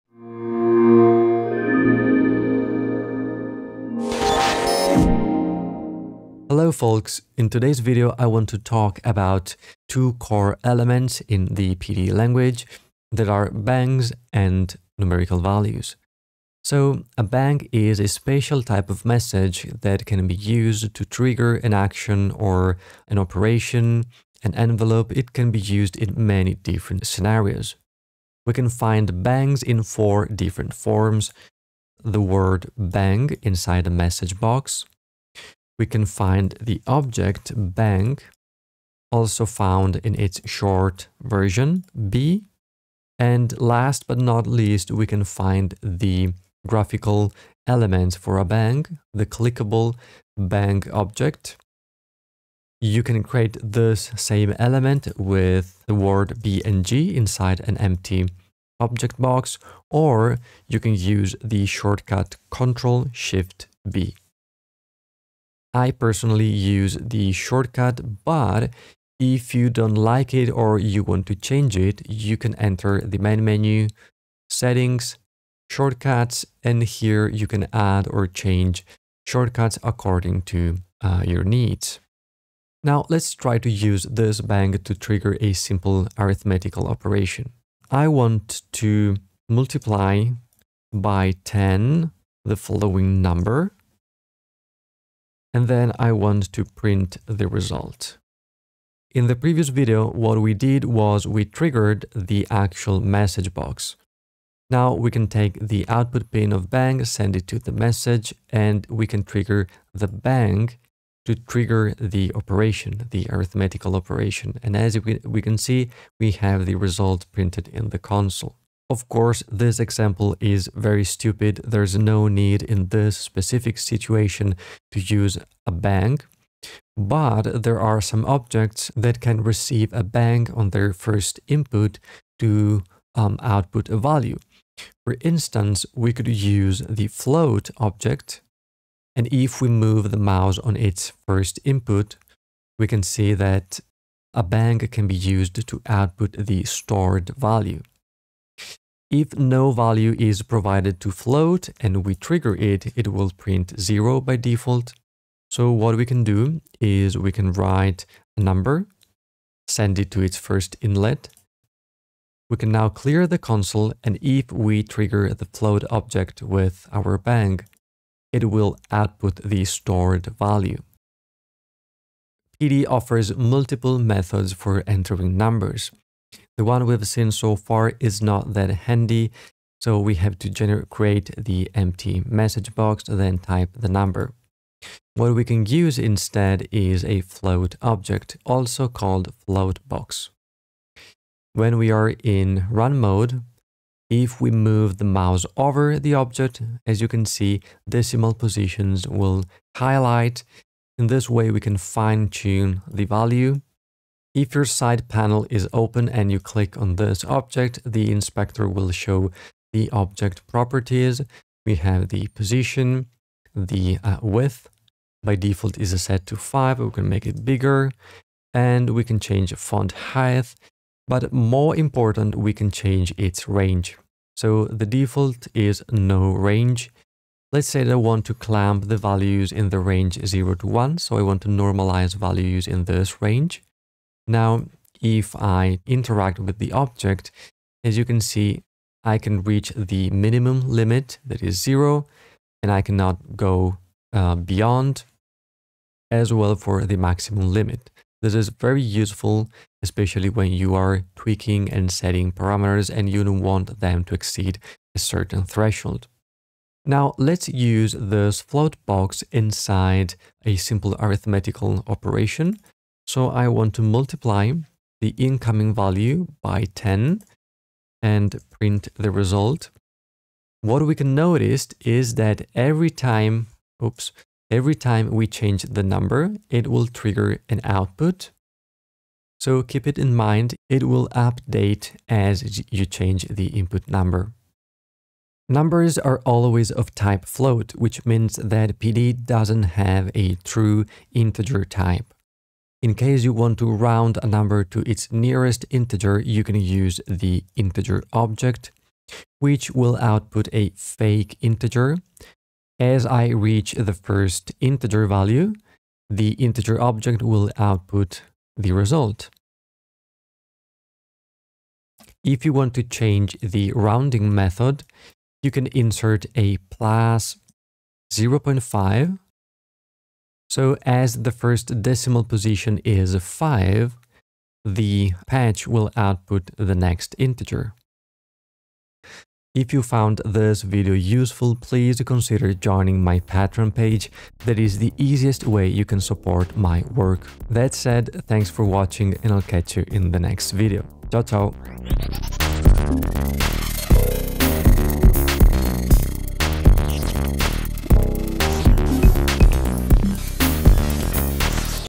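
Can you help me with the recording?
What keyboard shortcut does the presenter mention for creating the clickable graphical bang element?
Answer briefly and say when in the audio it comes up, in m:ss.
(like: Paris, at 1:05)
Ctrl Shift B, at 1:02.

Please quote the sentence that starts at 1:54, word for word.
And as we can see, we have the result printed in the console.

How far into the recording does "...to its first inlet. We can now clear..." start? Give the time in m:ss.
2:40.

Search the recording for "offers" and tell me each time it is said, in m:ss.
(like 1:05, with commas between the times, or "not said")
2:52.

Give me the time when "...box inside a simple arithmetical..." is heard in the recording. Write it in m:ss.
4:18.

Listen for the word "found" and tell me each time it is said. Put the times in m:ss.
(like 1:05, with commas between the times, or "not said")
0:39, 5:29.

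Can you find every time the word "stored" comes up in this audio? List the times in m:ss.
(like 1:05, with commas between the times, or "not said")
2:26, 2:49.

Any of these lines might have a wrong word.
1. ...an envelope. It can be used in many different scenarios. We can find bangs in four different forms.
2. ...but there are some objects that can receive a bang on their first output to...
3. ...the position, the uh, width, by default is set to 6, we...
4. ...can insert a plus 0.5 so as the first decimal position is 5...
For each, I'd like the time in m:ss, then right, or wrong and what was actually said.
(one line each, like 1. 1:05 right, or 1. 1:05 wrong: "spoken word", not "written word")
1. 0:24 right
2. 2:06 wrong: "input", not "output"
3. 3:32 wrong: "5", not "6"
4. 5:15 right.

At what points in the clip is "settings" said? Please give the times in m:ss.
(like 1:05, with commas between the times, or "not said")
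1:14, 4:11.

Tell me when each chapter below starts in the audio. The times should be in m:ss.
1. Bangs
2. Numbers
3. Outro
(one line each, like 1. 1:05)
1. 0:16
2. 2:51
3. 5:29.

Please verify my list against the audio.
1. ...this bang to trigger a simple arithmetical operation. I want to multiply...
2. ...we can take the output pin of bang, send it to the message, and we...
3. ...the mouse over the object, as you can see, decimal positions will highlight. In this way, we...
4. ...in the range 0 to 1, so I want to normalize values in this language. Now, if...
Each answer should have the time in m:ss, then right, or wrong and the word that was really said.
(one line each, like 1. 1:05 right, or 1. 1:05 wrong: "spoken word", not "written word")
1. 1:24 right
2. 1:44 right
3. 3:14 right
4. 3:49 wrong: "range", not "language".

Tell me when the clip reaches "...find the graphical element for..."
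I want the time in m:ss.
0:45.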